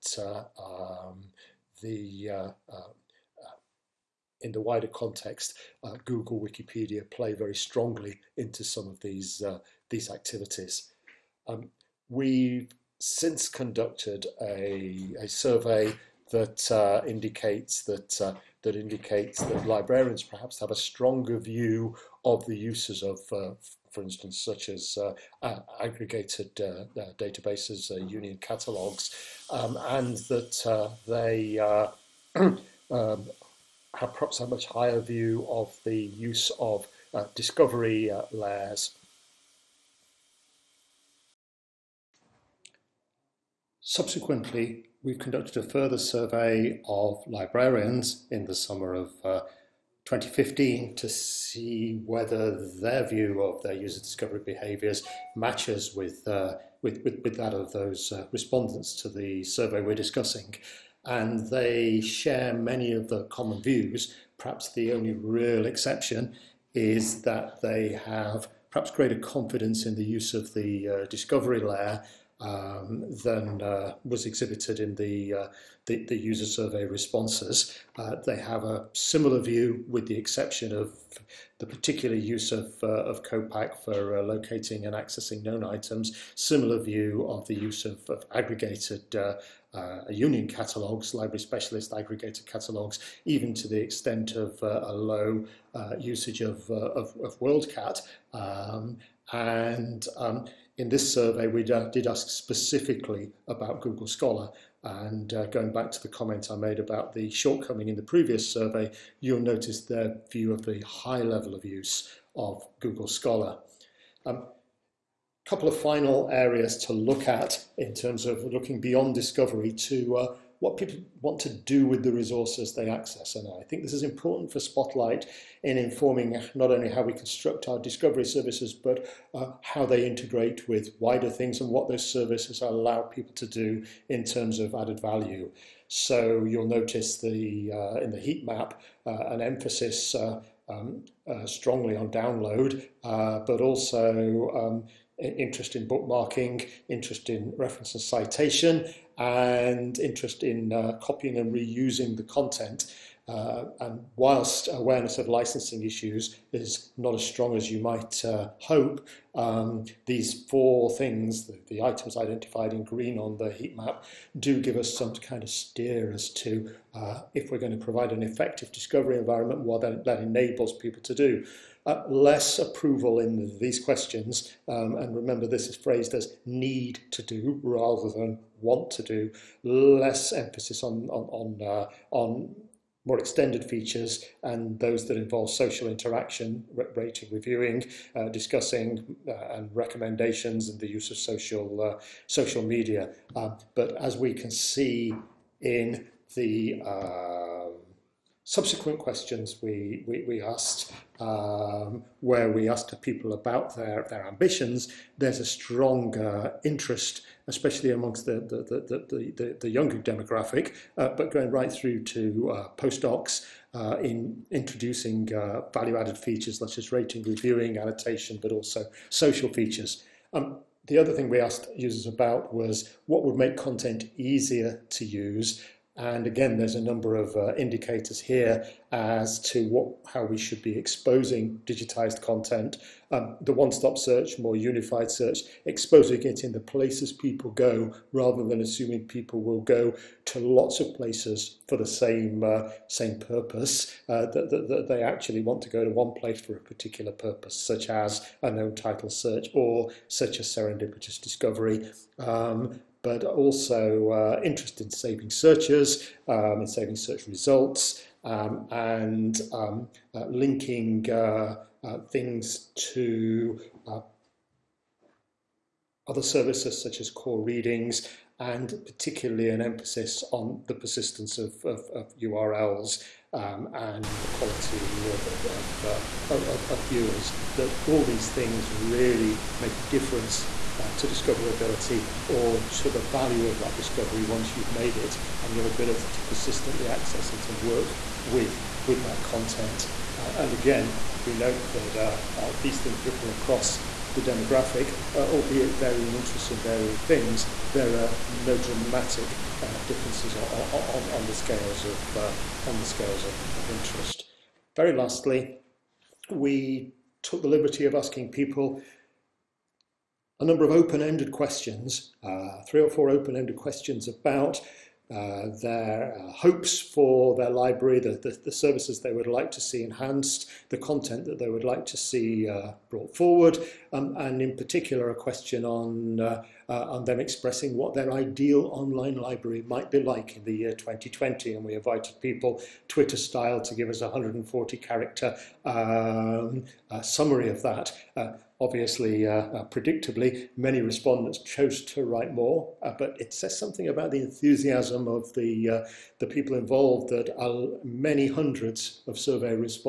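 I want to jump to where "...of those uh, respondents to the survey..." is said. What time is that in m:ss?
0:57.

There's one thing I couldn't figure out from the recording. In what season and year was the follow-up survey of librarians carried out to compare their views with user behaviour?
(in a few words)
summer of 2015.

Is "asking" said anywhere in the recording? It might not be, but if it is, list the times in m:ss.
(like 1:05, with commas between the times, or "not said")
5:07.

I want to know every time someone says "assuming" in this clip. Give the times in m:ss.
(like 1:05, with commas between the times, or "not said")
3:58.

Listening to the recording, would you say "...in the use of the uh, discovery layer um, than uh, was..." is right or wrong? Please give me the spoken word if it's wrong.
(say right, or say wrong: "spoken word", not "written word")
right.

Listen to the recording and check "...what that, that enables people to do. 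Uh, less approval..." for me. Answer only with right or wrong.
right.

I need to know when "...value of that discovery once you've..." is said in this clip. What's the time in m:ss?
4:43.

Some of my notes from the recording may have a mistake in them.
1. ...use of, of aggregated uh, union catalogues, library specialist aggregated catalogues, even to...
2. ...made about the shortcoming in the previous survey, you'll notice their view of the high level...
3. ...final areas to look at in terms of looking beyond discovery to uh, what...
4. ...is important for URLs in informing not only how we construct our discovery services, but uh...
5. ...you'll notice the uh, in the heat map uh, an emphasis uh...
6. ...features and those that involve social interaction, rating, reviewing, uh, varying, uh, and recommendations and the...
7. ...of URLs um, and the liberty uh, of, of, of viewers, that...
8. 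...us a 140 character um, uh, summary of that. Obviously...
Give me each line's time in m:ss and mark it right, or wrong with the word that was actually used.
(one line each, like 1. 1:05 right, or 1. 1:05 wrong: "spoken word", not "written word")
1. 1:27 right
2. 1:46 right
3. 1:55 right
4. 2:03 wrong: "Spotlight", not "URLs"
5. 2:16 right
6. 3:03 wrong: "discussing", not "varying"
7. 4:31 wrong: "quality", not "liberty"
8. 5:33 right.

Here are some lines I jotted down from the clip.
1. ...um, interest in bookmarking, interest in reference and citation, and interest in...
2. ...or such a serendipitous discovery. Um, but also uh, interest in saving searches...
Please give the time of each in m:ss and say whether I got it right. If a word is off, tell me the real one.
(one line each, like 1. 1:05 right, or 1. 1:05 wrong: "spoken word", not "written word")
1. 2:24 right
2. 4:09 right.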